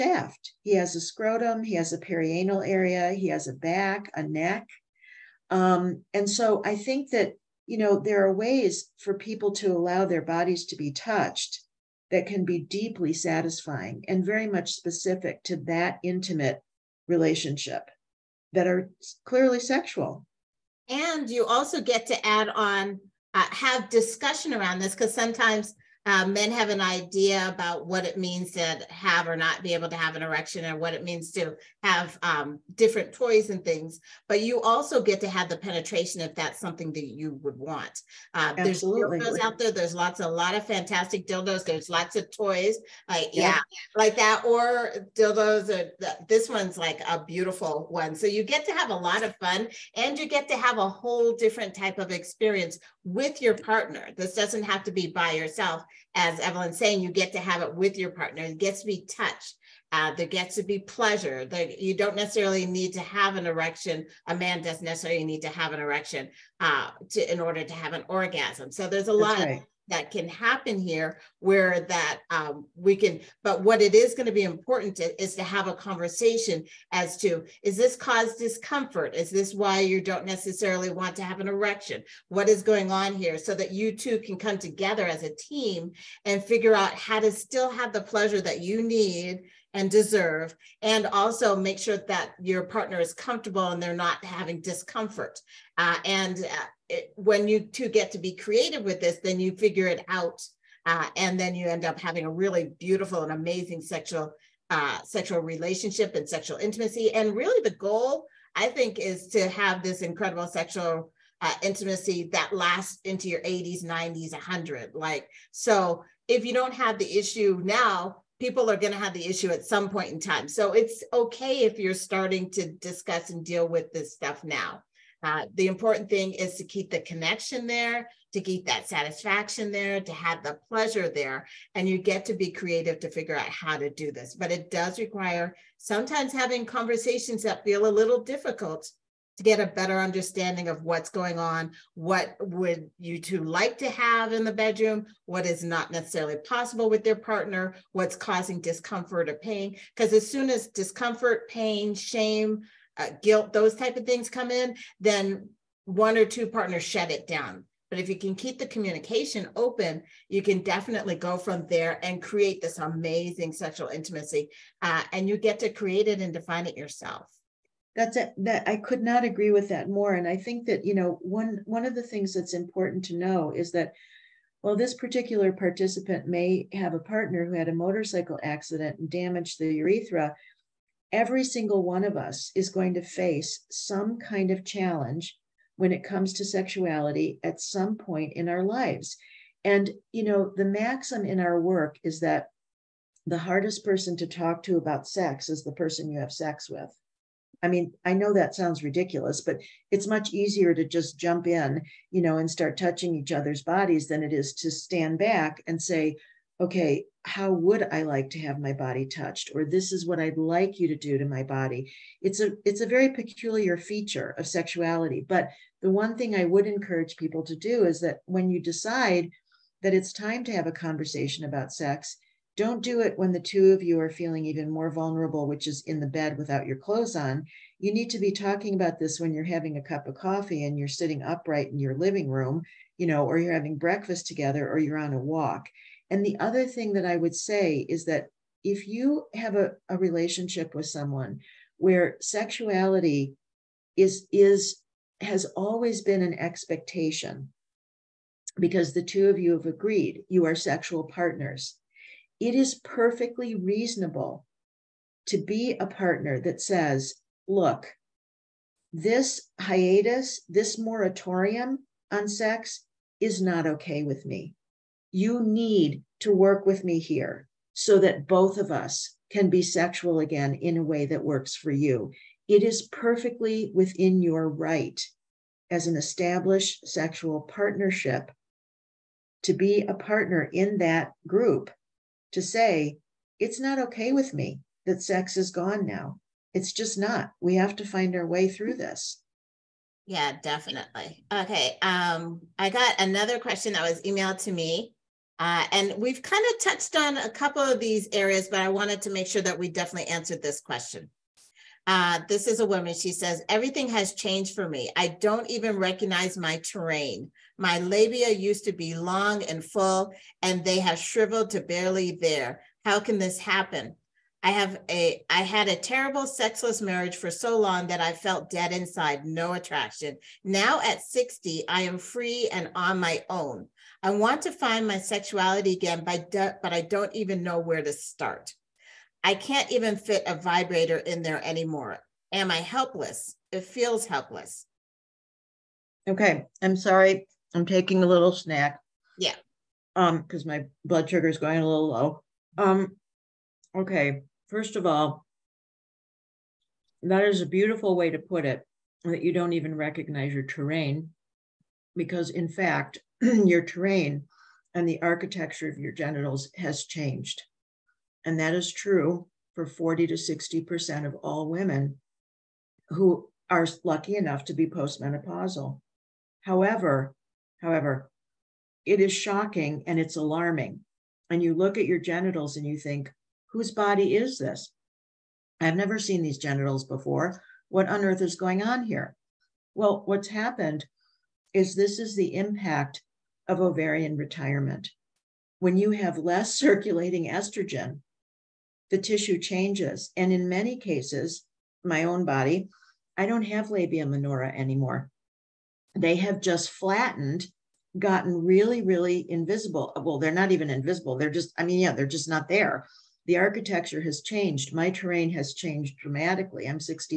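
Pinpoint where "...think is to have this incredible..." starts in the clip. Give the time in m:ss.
1:48.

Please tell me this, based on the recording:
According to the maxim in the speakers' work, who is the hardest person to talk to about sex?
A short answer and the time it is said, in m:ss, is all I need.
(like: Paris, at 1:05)
The person you have sex with, at 3:15.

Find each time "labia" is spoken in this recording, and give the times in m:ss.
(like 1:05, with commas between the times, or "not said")
5:07, 6:33.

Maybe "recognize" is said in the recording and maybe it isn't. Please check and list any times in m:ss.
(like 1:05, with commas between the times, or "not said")
5:05, 5:49.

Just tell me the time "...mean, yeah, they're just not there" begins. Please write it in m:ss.
6:41.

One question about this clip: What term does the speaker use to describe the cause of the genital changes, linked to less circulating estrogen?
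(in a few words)
Ovarian retirement.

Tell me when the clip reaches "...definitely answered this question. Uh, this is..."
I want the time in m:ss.
4:59.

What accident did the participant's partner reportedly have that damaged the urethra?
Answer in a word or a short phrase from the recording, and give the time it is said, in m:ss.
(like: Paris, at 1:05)
Motorcycle accident, at 2:57.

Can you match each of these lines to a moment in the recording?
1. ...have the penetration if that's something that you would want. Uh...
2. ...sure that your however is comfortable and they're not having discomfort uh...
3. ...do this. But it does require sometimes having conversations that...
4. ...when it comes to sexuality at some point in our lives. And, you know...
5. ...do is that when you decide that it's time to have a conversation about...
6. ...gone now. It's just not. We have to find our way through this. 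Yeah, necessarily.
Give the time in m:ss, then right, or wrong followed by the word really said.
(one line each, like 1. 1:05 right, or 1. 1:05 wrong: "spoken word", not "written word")
1. 0:35 right
2. 1:31 wrong: "partner", not "however"
3. 2:13 right
4. 3:05 right
5. 3:37 right
6. 4:45 wrong: "definitely", not "necessarily".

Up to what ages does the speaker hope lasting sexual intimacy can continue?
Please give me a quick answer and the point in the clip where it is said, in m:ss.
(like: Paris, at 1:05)
80s, 90s, 100, at 1:53.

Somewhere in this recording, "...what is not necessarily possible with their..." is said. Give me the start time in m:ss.
2:25.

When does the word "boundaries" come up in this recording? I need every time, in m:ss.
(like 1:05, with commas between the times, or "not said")
not said.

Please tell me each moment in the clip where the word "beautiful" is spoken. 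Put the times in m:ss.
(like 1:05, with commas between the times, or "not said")
0:47, 1:42, 5:47.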